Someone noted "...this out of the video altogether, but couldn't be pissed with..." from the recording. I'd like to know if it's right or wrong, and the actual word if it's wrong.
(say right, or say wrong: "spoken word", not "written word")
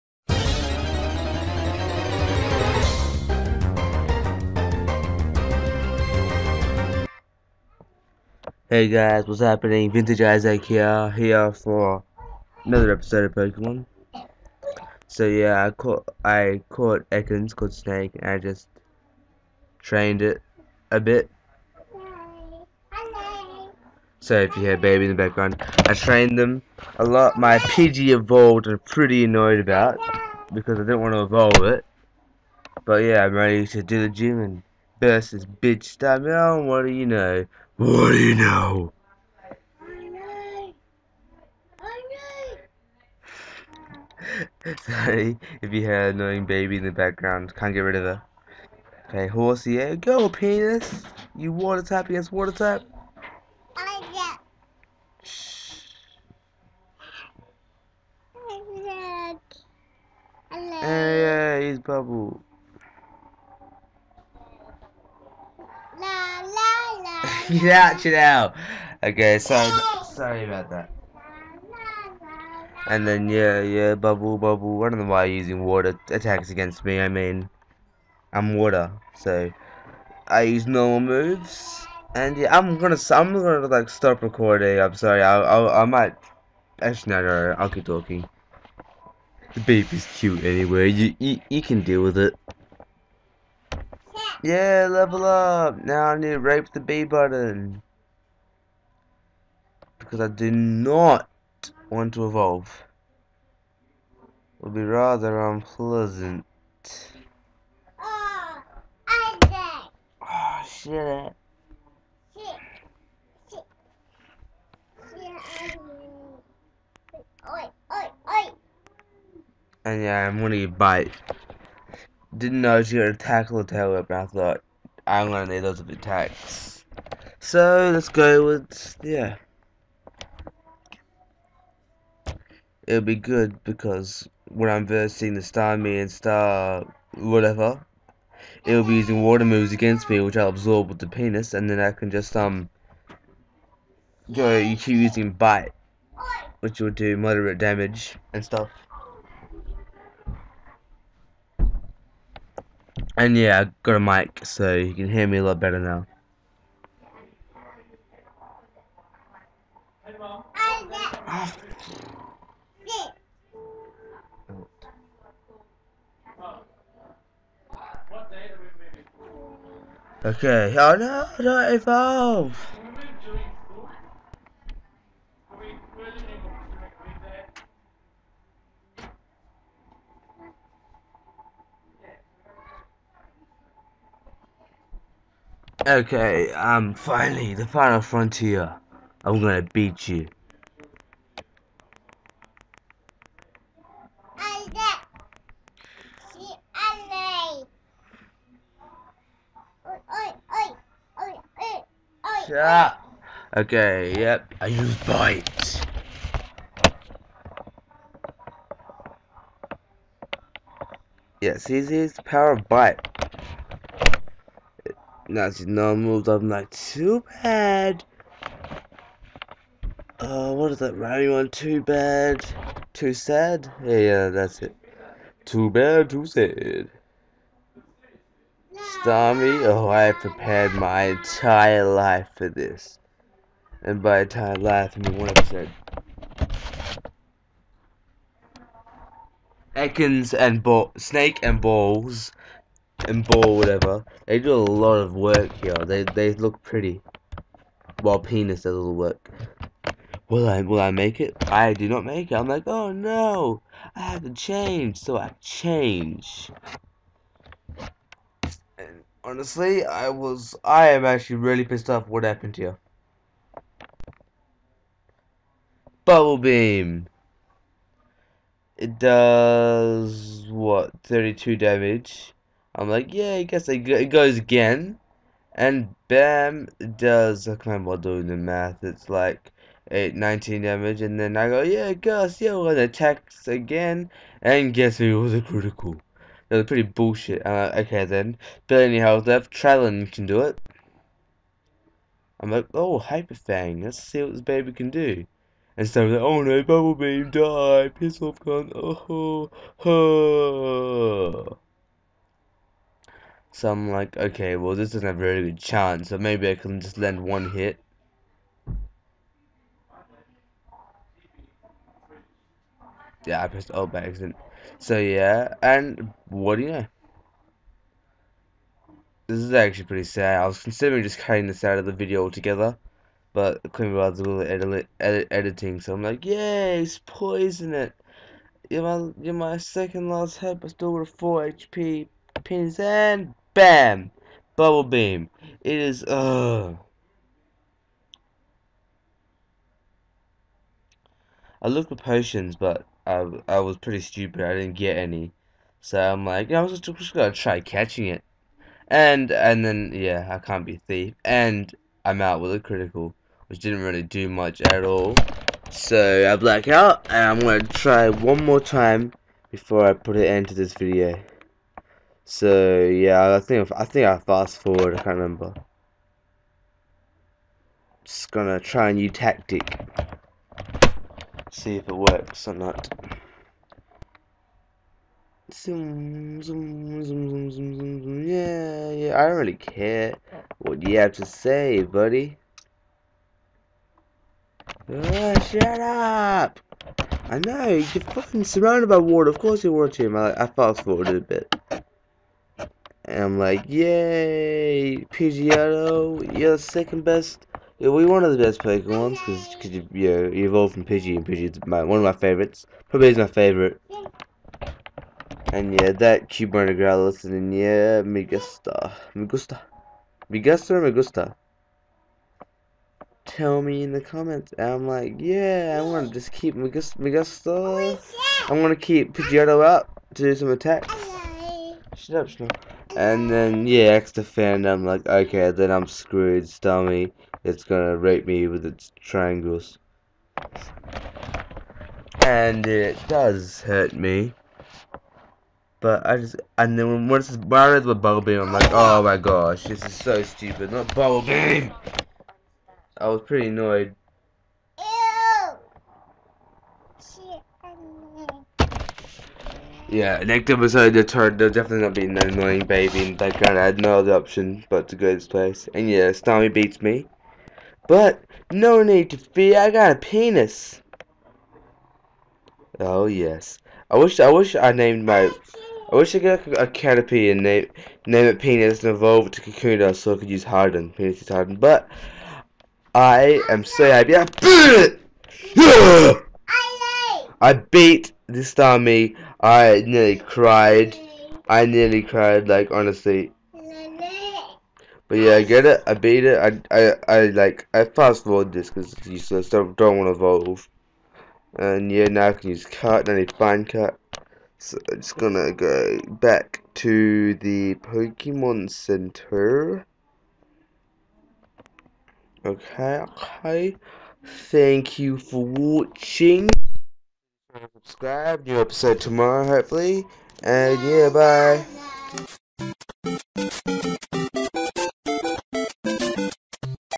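wrong: "bothered", not "pissed".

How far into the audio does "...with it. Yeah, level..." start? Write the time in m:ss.
1:32.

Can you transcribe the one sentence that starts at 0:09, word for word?
Vintage Isaac here, here for another episode of Pokemon.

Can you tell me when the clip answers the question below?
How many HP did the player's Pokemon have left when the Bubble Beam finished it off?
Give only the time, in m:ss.
5:31.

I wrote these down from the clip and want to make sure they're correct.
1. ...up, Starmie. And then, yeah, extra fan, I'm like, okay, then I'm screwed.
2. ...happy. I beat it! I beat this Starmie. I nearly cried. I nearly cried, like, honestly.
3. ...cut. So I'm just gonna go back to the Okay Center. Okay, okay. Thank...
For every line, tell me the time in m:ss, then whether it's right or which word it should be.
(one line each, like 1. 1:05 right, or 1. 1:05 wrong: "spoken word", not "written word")
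1. 7:02 wrong: "Snow", not "Starmie"
2. 7:53 right
3. 8:13 wrong: "Pokemon", not "Okay".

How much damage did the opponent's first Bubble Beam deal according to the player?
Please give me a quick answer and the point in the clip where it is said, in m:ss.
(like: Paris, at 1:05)
32, at 4:31.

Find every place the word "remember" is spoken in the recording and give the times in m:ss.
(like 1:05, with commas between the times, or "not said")
4:37, 6:05.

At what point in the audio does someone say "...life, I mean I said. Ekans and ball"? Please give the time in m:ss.
3:54.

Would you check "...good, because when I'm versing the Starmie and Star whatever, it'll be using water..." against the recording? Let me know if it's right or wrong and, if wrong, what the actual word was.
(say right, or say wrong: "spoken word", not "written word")
right.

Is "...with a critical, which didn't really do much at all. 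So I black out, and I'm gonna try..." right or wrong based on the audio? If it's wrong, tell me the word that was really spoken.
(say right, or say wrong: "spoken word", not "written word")
right.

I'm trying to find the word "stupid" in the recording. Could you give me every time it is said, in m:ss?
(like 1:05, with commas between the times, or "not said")
5:43, 7:20.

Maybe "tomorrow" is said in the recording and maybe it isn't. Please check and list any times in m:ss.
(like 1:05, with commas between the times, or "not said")
8:29.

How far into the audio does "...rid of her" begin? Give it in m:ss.
0:47.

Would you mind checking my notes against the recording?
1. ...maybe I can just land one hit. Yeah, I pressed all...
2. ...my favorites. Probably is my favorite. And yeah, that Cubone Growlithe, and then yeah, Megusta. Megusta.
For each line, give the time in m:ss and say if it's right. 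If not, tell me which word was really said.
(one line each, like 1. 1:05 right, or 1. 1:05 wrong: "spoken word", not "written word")
1. 5:06 right
2. 6:42 right.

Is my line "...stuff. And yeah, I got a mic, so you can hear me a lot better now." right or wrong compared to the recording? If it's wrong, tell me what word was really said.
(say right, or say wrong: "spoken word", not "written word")
right.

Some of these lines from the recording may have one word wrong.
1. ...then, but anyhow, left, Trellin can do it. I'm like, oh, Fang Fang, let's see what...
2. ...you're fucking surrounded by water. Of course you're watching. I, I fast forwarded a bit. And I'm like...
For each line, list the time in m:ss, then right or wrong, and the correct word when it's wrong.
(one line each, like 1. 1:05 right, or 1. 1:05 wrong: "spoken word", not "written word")
1. 4:48 wrong: "Hyper", not "Fang"
2. 6:27 right.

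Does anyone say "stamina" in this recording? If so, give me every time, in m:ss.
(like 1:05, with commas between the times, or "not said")
0:35.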